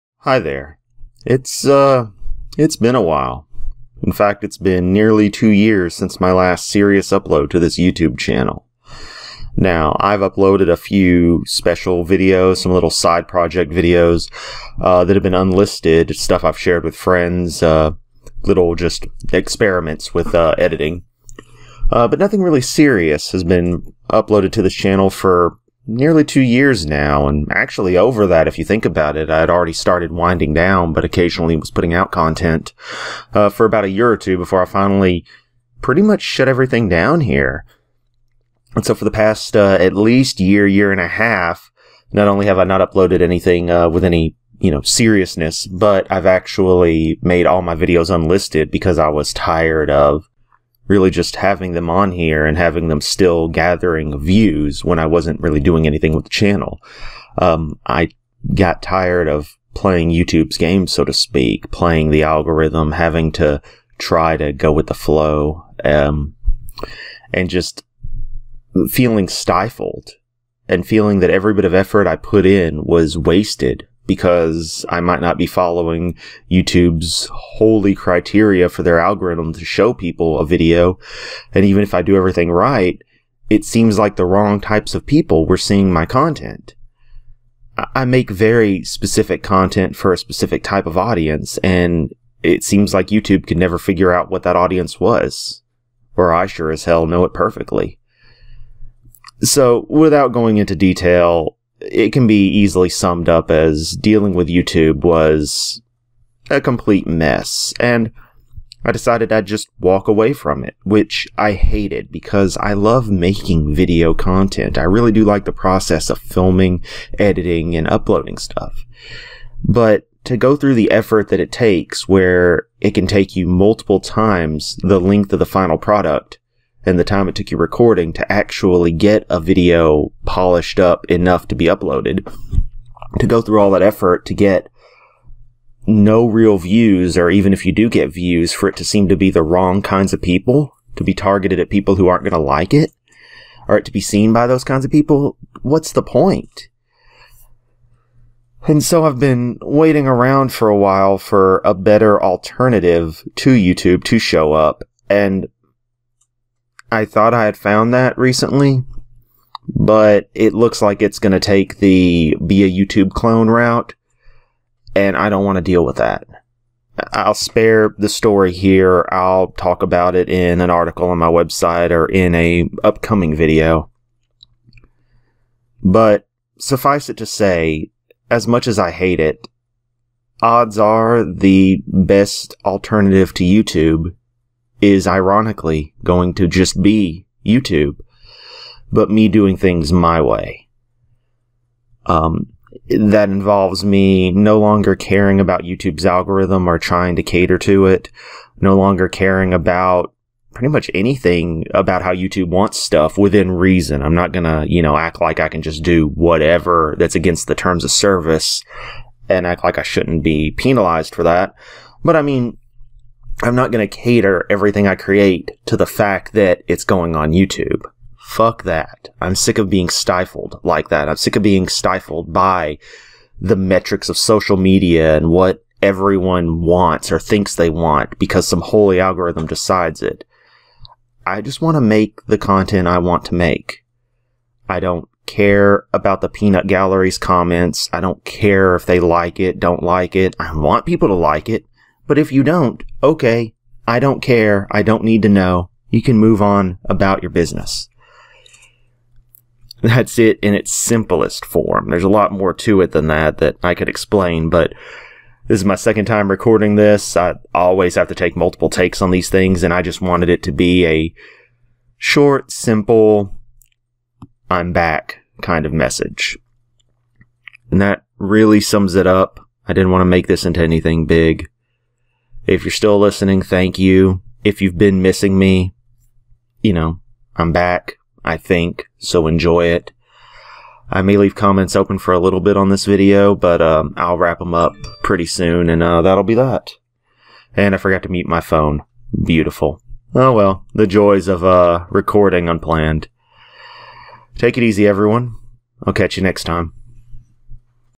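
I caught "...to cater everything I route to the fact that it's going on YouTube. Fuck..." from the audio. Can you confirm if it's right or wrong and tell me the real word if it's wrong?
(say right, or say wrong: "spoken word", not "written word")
wrong: "create", not "route".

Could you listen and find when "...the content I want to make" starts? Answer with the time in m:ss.
3:52.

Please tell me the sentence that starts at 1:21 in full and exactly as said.
And even if I do everything right, it seems like the wrong types of people were seeing my content.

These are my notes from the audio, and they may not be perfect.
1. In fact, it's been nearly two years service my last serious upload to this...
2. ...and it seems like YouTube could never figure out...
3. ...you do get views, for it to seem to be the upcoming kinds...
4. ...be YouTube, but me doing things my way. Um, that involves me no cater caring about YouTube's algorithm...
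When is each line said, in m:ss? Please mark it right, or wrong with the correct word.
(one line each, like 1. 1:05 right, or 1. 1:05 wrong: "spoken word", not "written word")
1. 0:04 wrong: "since", not "service"
2. 1:31 right
3. 2:17 wrong: "wrong", not "upcoming"
4. 3:06 wrong: "longer", not "cater".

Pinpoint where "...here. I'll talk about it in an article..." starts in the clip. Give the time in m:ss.
2:48.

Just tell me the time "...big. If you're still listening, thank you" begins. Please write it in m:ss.
4:31.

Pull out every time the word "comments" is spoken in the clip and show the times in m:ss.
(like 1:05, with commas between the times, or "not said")
3:57, 4:41.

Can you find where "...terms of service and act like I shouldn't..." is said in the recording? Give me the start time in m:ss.
3:27.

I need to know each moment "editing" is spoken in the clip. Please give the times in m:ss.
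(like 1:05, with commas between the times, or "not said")
0:20, 1:57.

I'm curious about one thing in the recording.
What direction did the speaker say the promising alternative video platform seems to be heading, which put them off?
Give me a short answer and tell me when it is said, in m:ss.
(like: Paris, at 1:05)
YouTube clone, at 2:42.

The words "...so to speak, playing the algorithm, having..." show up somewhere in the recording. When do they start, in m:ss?
1:00.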